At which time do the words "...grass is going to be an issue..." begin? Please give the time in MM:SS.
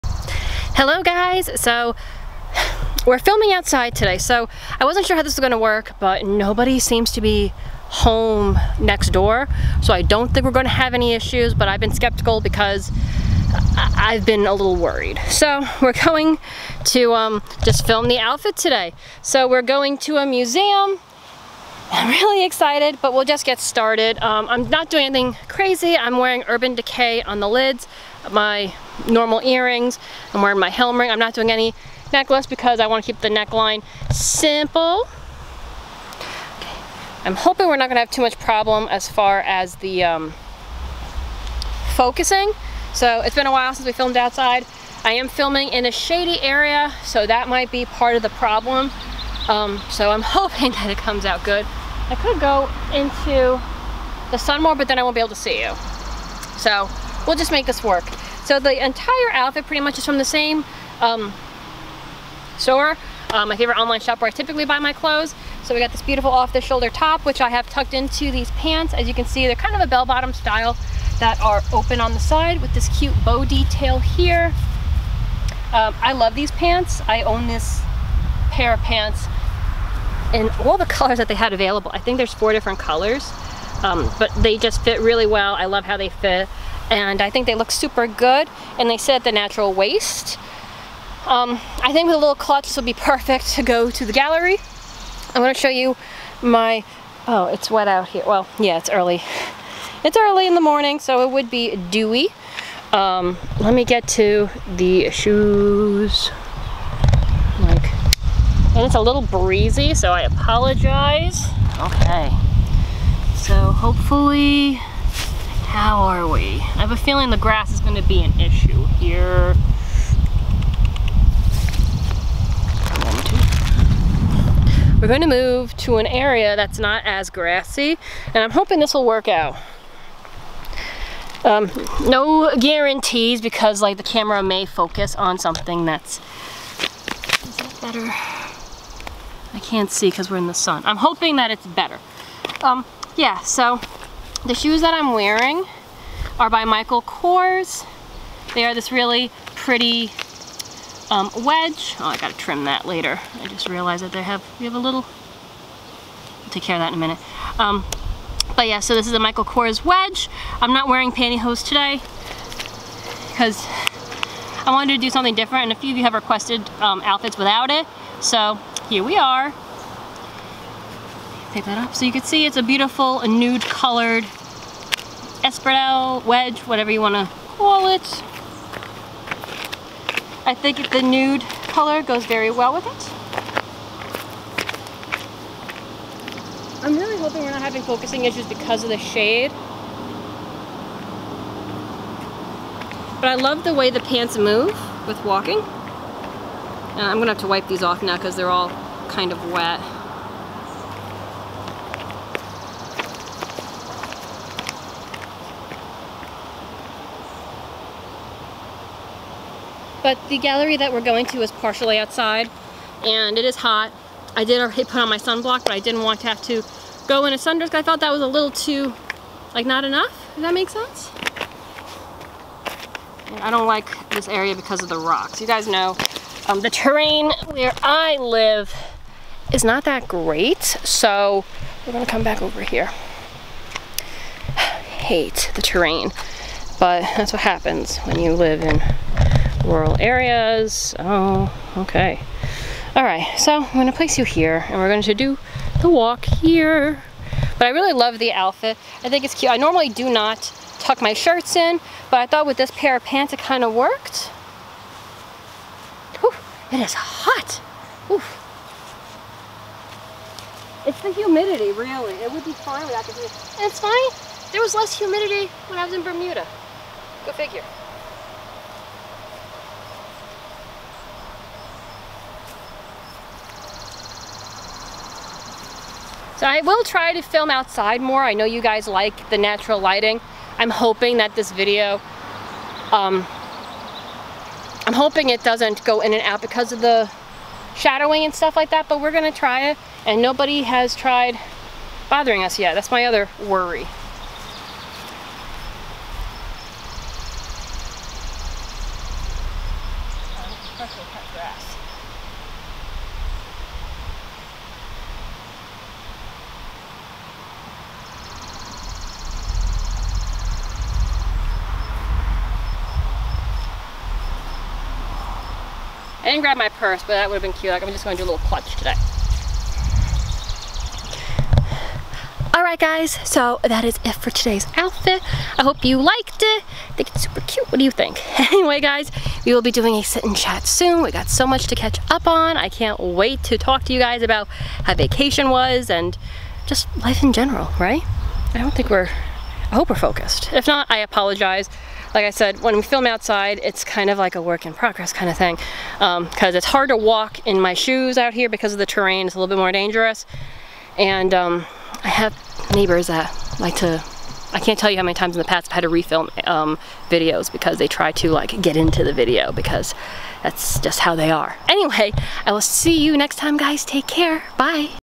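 01:57.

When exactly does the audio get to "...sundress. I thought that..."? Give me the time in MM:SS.
03:37.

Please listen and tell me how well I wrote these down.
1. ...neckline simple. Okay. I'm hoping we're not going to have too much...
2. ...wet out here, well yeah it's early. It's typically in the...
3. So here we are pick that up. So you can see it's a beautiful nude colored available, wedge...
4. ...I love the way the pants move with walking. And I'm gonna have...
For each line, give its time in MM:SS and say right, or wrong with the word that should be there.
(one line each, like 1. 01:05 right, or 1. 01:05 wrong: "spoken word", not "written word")
1. 00:33 right
2. 01:37 wrong: "early", not "typically"
3. 02:48 wrong: "espadrille", not "available"
4. 03:13 right.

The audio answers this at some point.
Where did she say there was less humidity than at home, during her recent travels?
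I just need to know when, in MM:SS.
04:26.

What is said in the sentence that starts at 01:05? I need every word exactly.
So we got this beautiful off-the-shoulder top, which I have tucked into these pants.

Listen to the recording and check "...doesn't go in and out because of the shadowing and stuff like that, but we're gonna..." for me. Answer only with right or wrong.
right.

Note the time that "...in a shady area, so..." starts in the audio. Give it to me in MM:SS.
00:45.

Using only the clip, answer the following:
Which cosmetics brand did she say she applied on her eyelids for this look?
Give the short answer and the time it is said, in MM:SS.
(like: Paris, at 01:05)
Urban Decay, at 00:26.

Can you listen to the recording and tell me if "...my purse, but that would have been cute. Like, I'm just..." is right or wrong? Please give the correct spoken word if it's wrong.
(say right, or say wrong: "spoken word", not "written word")
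right.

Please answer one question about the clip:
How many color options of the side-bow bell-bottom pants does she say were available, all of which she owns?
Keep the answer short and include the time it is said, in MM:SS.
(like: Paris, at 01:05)
4, at 01:22.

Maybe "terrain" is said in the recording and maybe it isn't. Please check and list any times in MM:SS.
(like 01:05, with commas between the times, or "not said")
03:46, 03:55, 05:48.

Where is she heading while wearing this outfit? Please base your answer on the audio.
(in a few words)
A museum.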